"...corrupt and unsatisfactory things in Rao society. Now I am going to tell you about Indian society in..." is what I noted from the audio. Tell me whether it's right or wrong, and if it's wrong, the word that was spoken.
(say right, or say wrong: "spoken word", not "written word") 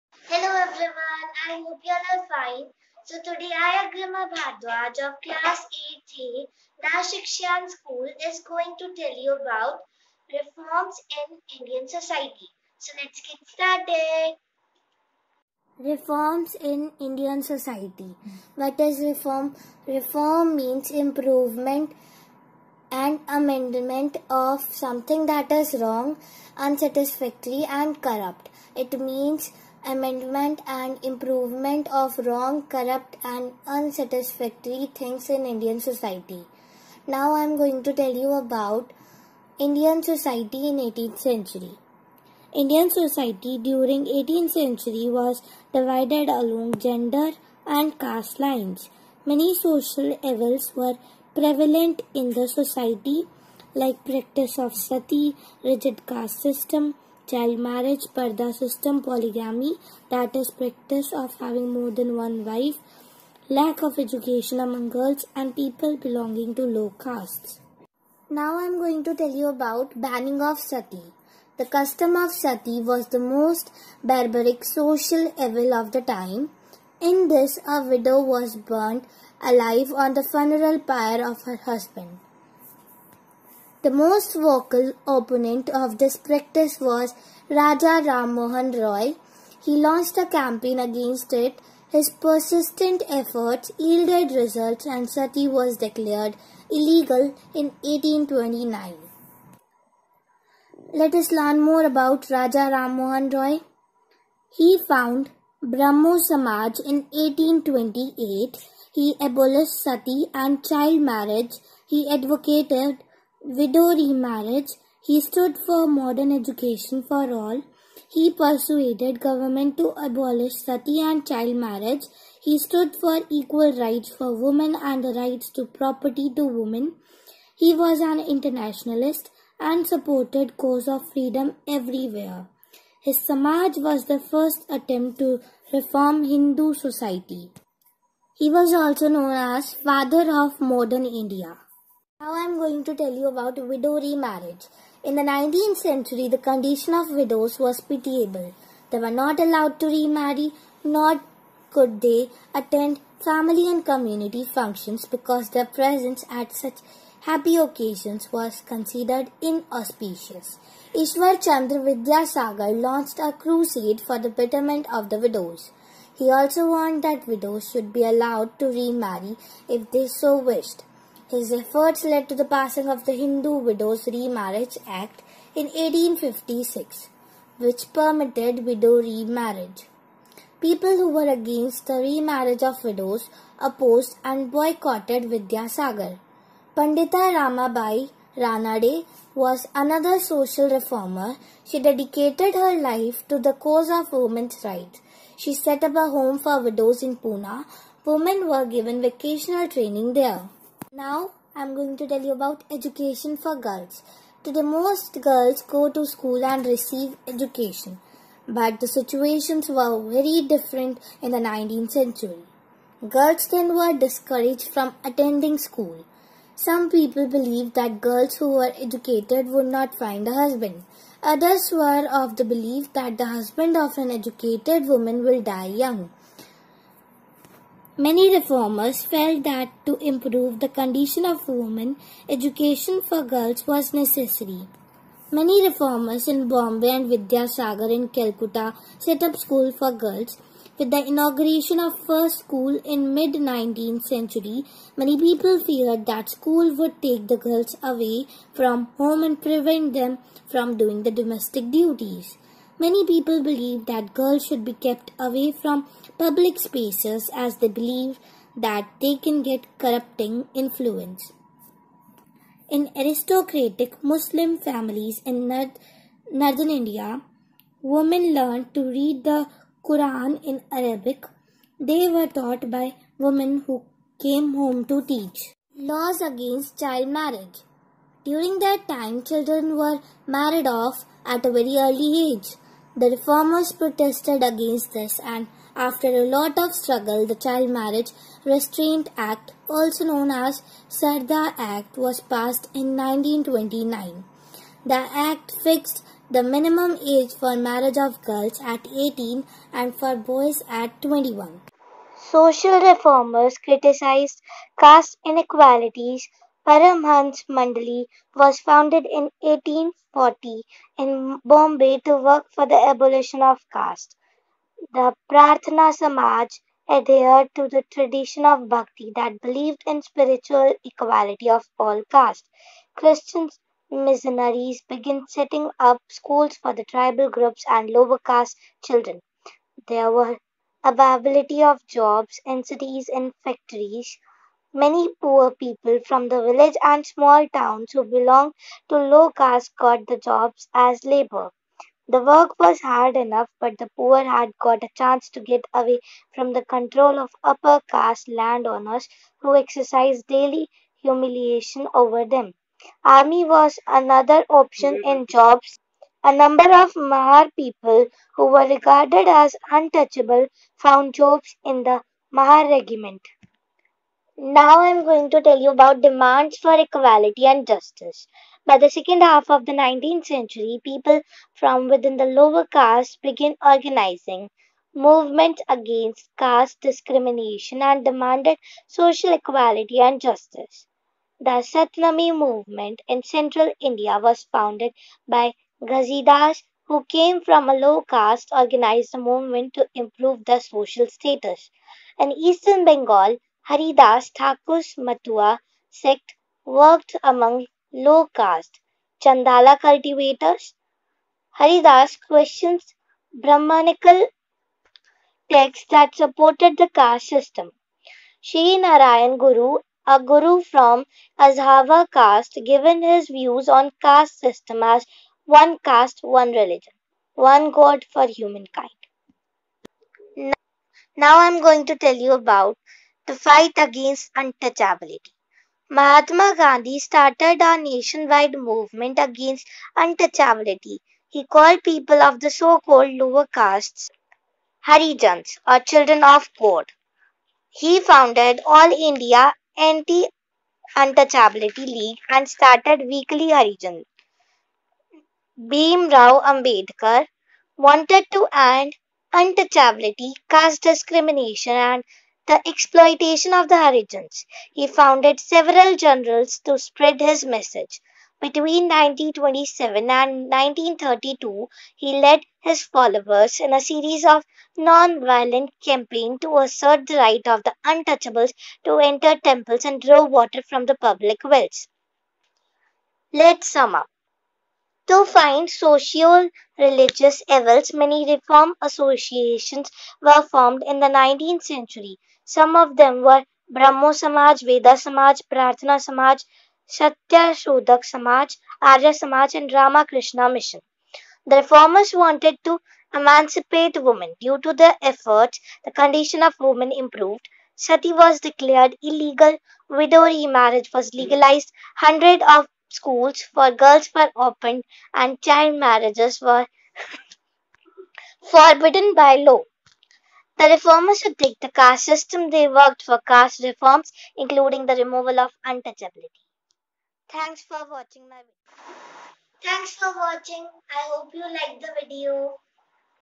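wrong: "Indian", not "Rao".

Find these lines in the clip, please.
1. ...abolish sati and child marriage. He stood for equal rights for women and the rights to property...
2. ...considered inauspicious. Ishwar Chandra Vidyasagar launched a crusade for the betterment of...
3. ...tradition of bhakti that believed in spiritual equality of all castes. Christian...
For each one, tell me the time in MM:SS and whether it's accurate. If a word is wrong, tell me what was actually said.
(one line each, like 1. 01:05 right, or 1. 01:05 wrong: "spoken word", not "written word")
1. 01:59 right
2. 02:38 right
3. 05:17 right.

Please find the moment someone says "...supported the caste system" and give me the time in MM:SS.
06:46.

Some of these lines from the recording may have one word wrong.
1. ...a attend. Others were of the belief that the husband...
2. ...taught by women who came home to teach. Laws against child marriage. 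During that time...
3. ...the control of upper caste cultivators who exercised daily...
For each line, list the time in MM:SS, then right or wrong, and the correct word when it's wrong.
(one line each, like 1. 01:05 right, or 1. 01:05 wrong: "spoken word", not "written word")
1. 03:40 wrong: "husband", not "attend"
2. 04:32 right
3. 05:46 wrong: "landowners", not "cultivators".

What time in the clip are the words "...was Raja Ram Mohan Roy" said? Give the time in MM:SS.
01:26.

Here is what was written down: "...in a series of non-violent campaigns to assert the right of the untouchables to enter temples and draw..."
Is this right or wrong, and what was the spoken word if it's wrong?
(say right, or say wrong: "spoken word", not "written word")
right.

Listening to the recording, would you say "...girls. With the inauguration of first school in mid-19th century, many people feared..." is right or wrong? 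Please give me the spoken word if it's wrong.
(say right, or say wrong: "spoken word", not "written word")
right.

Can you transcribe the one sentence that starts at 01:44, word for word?
He found Brahmo Samaj in 1828.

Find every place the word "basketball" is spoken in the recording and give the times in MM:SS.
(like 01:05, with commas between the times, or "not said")
not said.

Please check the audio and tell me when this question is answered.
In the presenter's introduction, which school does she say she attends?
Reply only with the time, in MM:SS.
00:06.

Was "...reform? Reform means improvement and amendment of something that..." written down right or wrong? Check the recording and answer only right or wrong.
right.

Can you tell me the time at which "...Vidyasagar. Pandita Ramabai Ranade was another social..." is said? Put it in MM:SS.
03:05.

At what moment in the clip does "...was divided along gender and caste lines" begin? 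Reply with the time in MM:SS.
00:45.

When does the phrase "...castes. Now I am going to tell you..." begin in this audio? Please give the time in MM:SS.
01:07.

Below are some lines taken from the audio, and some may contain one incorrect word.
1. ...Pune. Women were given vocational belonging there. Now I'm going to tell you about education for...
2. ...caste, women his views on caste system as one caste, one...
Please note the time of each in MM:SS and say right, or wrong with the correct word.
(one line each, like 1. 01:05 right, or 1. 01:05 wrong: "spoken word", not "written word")
1. 03:17 wrong: "training", not "belonging"
2. 06:52 wrong: "given", not "women".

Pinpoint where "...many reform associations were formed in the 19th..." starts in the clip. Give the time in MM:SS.
07:57.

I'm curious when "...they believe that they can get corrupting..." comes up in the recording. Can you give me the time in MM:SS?
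04:17.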